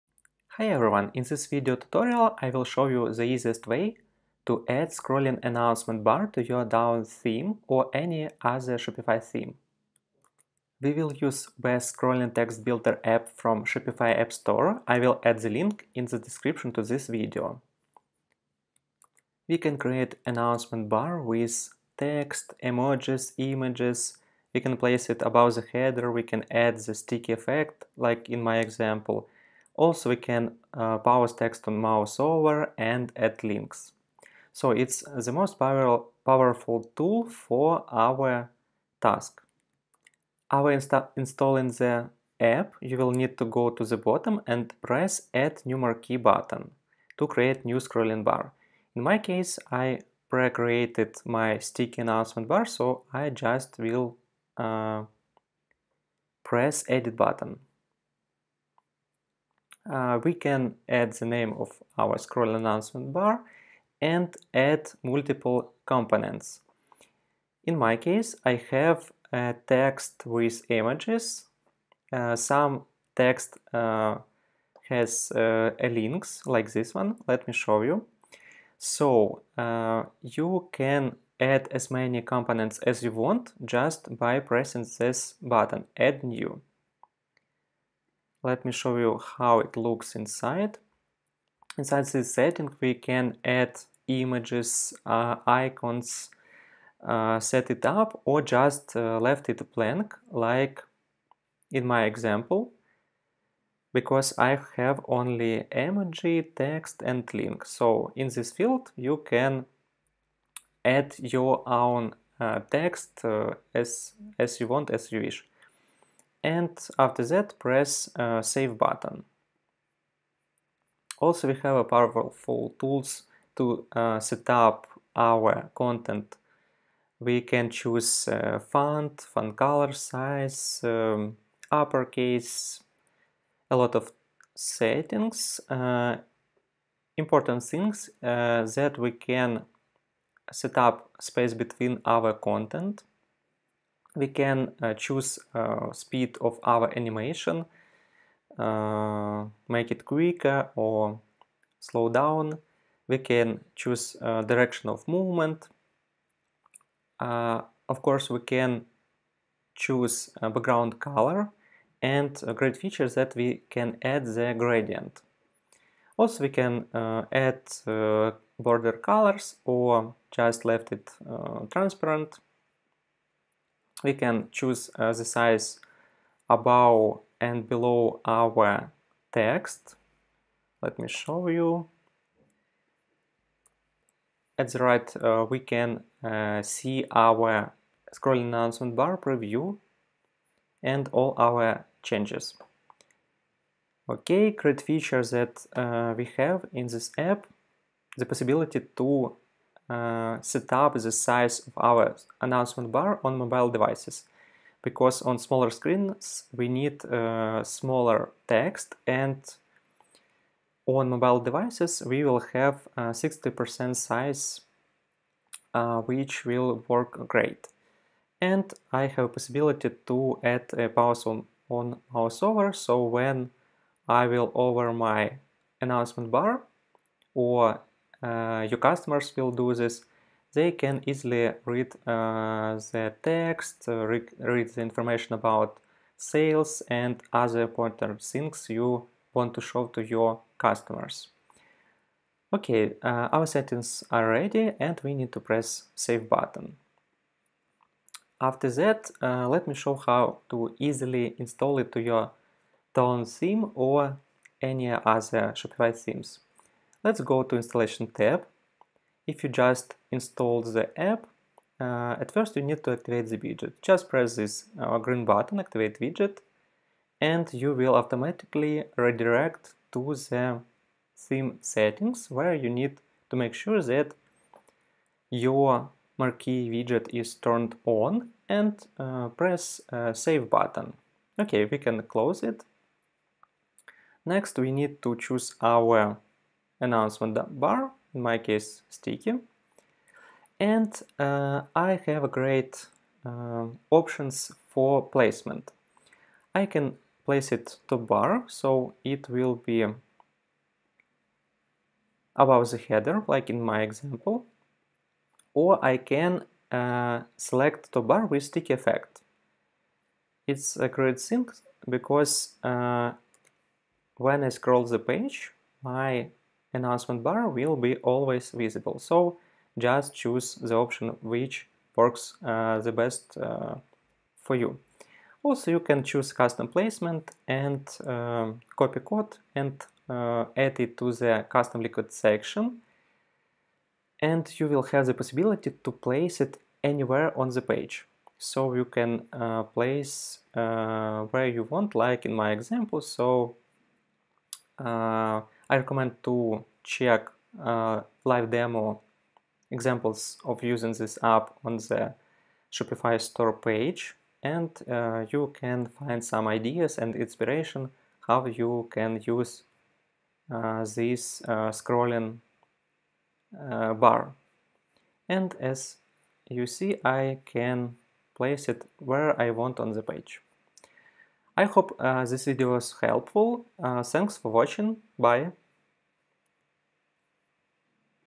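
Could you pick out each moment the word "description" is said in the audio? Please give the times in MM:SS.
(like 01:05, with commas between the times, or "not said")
00:16.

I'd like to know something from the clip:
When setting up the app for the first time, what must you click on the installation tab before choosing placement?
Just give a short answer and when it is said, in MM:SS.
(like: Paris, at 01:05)
activate widget, at 04:25.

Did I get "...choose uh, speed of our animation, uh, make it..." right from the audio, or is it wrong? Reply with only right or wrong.
right.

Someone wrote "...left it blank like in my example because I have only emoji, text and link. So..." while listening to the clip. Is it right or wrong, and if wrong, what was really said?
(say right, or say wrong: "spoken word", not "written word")
right.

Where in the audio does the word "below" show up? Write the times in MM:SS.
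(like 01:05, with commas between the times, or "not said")
02:57.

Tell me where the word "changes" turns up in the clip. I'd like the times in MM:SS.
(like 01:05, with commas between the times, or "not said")
03:12.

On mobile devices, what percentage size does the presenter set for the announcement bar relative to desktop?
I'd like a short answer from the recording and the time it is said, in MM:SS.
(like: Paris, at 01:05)
60%, at 03:32.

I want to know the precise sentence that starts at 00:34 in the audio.
So it's the most powerful tool for our task.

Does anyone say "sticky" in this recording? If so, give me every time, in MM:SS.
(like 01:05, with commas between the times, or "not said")
00:26, 00:51, 04:48, 05:08.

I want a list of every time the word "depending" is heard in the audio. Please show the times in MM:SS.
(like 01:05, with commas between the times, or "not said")
not said.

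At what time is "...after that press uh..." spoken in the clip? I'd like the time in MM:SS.
01:56.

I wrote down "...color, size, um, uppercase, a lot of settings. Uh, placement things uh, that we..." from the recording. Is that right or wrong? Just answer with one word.
wrong.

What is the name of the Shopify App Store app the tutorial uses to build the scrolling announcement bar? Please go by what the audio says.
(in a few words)
Best Scrolling Text Builder.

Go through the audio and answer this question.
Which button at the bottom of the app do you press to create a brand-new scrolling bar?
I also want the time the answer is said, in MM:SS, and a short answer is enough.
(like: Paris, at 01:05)
Add New Marquee, at 00:45.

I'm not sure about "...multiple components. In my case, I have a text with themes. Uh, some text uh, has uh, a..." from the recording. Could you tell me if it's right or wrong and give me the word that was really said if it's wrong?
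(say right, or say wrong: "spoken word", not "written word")
wrong: "images", not "themes".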